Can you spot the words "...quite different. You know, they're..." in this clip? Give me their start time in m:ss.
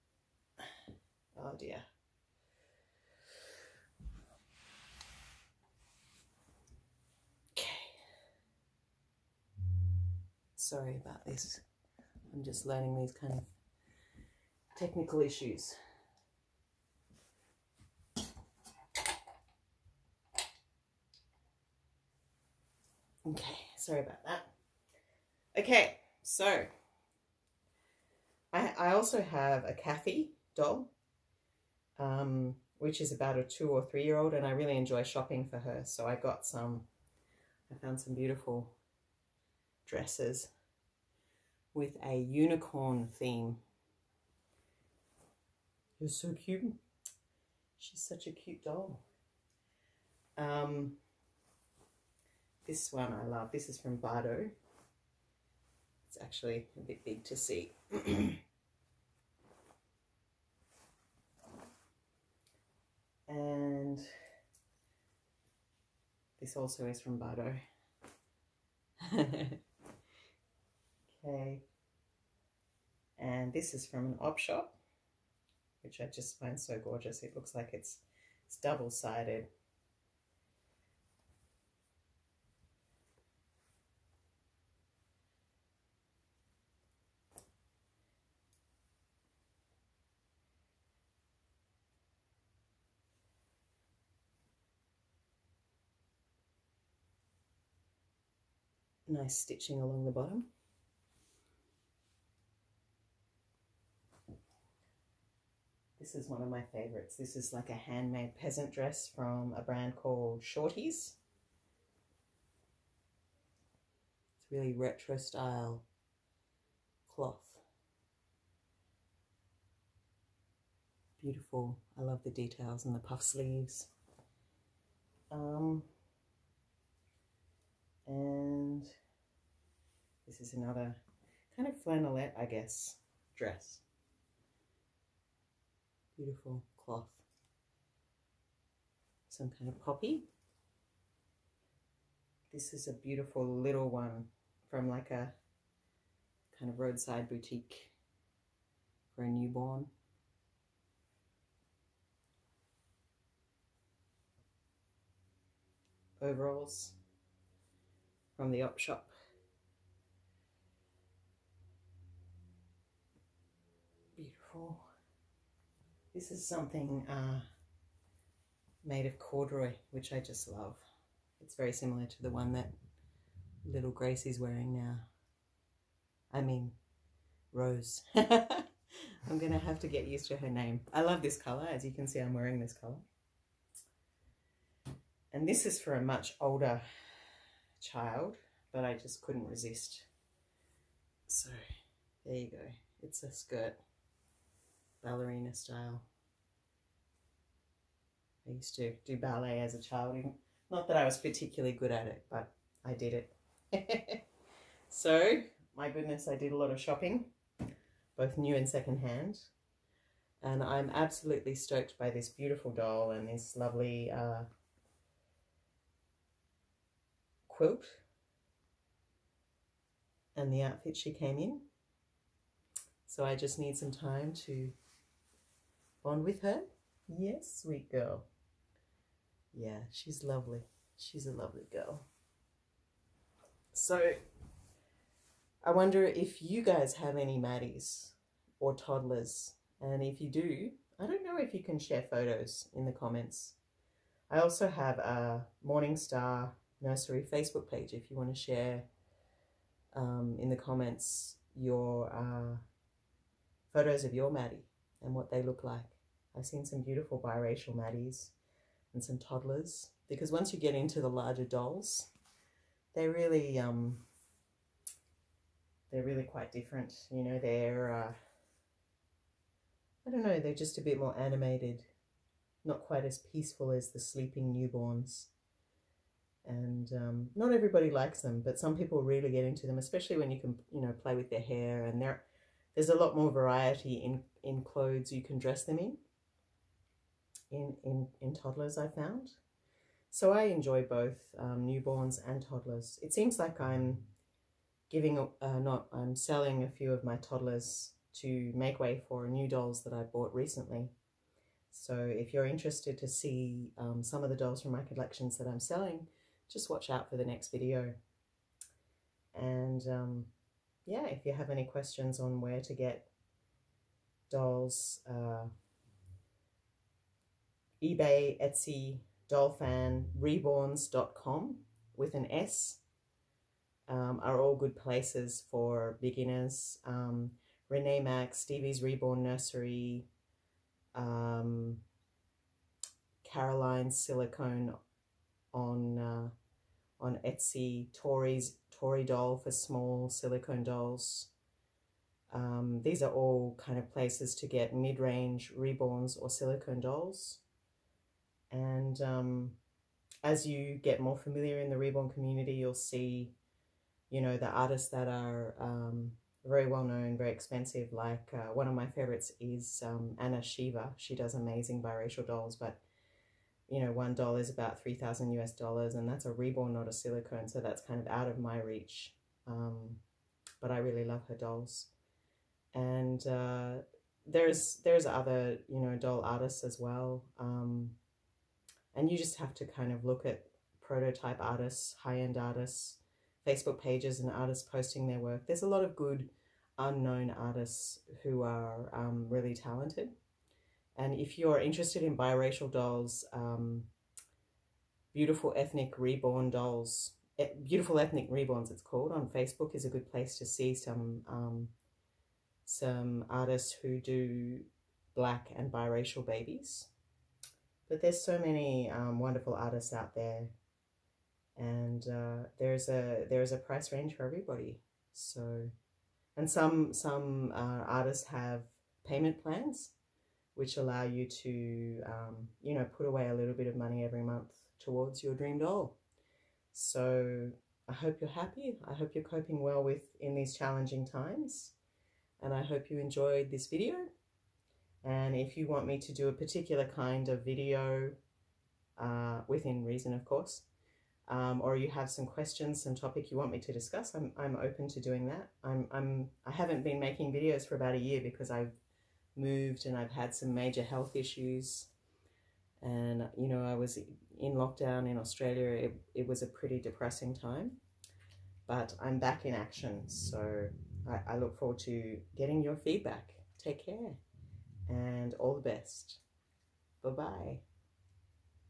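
4:26.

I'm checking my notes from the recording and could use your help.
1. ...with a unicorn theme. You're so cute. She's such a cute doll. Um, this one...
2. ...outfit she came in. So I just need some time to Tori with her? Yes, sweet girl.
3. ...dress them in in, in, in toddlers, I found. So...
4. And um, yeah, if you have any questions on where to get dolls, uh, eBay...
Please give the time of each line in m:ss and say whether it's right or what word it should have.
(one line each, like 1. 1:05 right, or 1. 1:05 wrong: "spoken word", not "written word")
1. 0:41 right
2. 3:40 wrong: "Born", not "Tori"
3. 4:45 right
4. 5:09 right.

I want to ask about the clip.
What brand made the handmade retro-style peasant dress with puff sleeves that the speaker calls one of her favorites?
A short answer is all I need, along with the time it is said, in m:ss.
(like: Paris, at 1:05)
Shorties, at 1:50.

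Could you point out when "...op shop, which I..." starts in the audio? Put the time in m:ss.
1:14.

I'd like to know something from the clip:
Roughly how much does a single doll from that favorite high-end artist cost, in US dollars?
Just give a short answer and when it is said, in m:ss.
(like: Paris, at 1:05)
3,000 US dollars, at 6:04.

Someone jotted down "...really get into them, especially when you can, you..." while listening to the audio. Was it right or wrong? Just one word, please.
right.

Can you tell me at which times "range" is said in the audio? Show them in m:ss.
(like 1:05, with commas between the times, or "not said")
5:44, 6:53.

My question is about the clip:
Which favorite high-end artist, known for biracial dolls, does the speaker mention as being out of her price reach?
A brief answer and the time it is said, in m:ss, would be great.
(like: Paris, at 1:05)
Anna Shiva, at 6:00.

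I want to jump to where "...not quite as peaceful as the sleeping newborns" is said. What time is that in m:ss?
4:32.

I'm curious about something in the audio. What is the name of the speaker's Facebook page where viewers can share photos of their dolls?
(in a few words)
Morning Star Nursery.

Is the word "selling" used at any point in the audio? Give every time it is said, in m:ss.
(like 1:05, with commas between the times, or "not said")
4:56, 5:05.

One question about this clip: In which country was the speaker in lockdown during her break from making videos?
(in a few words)
Australia.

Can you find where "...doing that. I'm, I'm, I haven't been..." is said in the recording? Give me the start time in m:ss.
7:25.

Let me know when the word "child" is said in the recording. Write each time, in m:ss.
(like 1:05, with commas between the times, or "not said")
3:07, 3:19.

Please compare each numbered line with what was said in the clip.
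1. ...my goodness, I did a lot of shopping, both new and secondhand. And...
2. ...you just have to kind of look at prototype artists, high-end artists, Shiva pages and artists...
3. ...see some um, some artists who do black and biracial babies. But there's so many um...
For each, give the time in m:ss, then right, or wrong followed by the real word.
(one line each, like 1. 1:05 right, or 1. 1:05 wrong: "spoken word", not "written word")
1. 3:25 right
2. 6:19 wrong: "Facebook", not "Shiva"
3. 6:40 right.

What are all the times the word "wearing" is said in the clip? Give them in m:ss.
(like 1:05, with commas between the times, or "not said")
2:54, 3:02.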